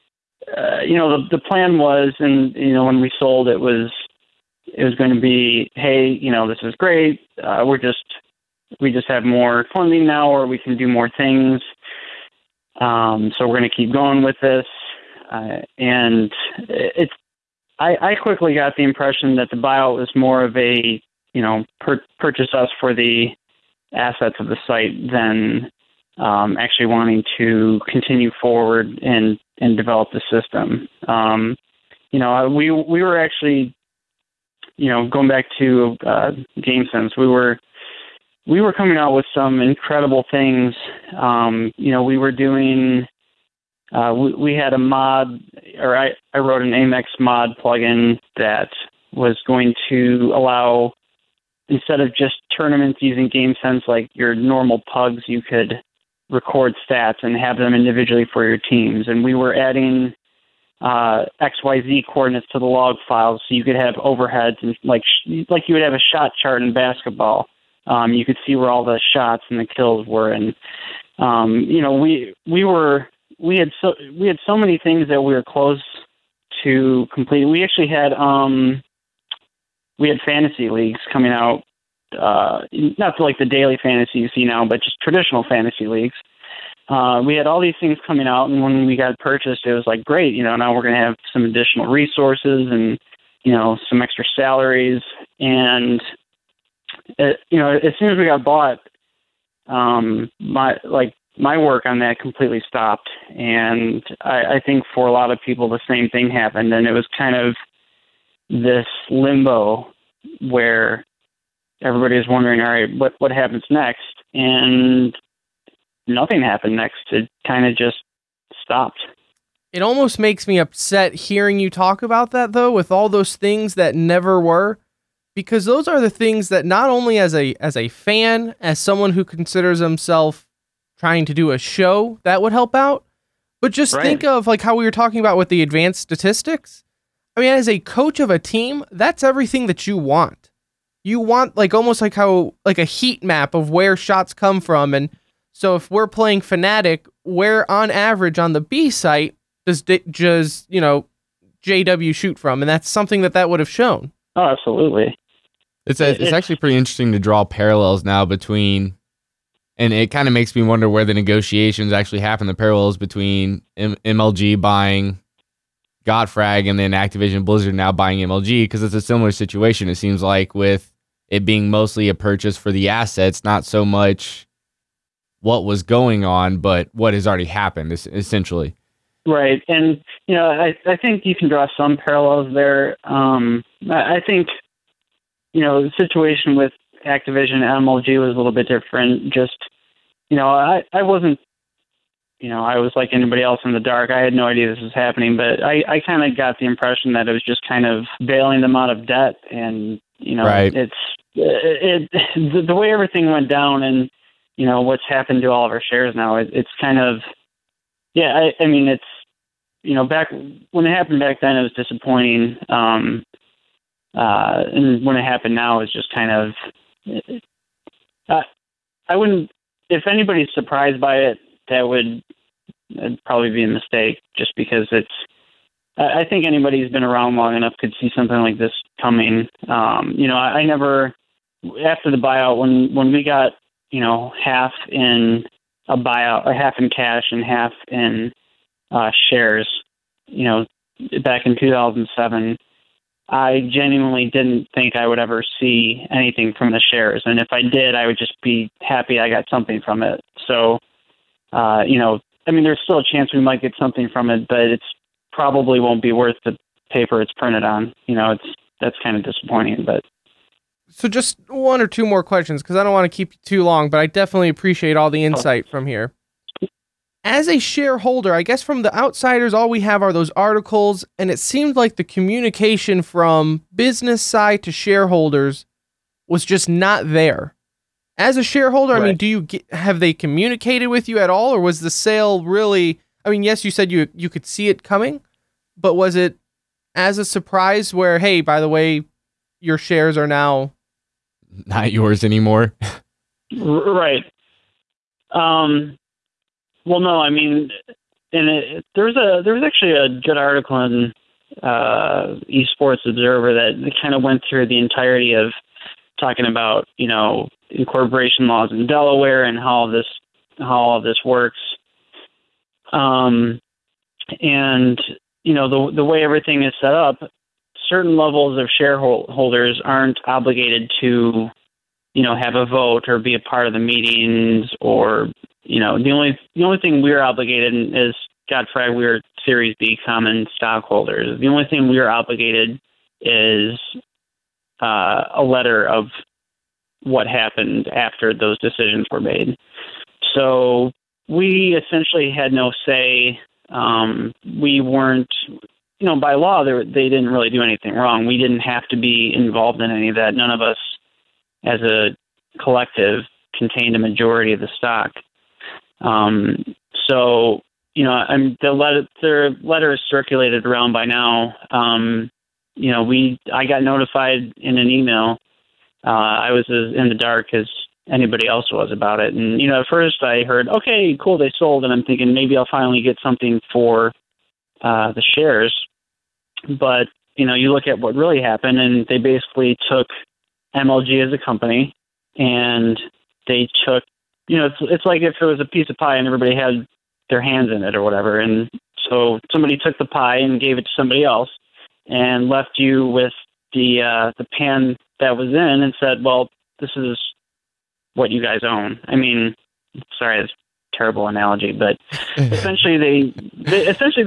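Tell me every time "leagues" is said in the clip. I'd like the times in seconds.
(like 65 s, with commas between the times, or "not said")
80 s, 85 s.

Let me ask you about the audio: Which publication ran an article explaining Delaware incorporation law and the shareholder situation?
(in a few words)
Esports Observer.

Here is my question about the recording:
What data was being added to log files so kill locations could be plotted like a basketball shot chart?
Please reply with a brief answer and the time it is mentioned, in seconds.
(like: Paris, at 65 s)
XYZ coordinates, at 61 s.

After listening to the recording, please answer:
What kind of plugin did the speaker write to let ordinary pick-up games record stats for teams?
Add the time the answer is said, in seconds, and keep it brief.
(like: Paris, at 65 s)
AMX Mod plugin, at 46 s.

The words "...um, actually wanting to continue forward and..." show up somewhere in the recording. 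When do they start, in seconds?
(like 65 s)
26 s.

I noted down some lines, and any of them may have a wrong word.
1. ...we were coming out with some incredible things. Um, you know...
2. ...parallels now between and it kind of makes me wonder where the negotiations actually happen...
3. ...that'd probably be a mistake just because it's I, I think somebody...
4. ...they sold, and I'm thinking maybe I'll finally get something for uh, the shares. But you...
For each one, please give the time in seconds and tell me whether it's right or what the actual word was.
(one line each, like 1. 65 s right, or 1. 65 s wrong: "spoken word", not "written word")
1. 38 s right
2. 157 s right
3. 222 s wrong: "anybody", not "somebody"
4. 371 s right.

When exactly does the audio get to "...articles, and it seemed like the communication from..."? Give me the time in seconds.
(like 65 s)
270 s.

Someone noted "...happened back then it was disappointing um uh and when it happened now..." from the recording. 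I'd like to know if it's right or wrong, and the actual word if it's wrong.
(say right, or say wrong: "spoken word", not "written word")
right.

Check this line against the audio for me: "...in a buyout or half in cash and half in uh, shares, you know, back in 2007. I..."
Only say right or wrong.
right.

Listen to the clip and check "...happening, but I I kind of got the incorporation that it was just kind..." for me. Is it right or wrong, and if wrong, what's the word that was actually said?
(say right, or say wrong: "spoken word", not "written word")
wrong: "impression", not "incorporation".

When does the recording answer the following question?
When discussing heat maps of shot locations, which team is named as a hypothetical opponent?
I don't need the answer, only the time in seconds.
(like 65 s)
146 s.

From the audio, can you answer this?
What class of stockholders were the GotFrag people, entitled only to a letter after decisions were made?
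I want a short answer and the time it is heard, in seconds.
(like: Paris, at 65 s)
Series B common stockholders, at 329 s.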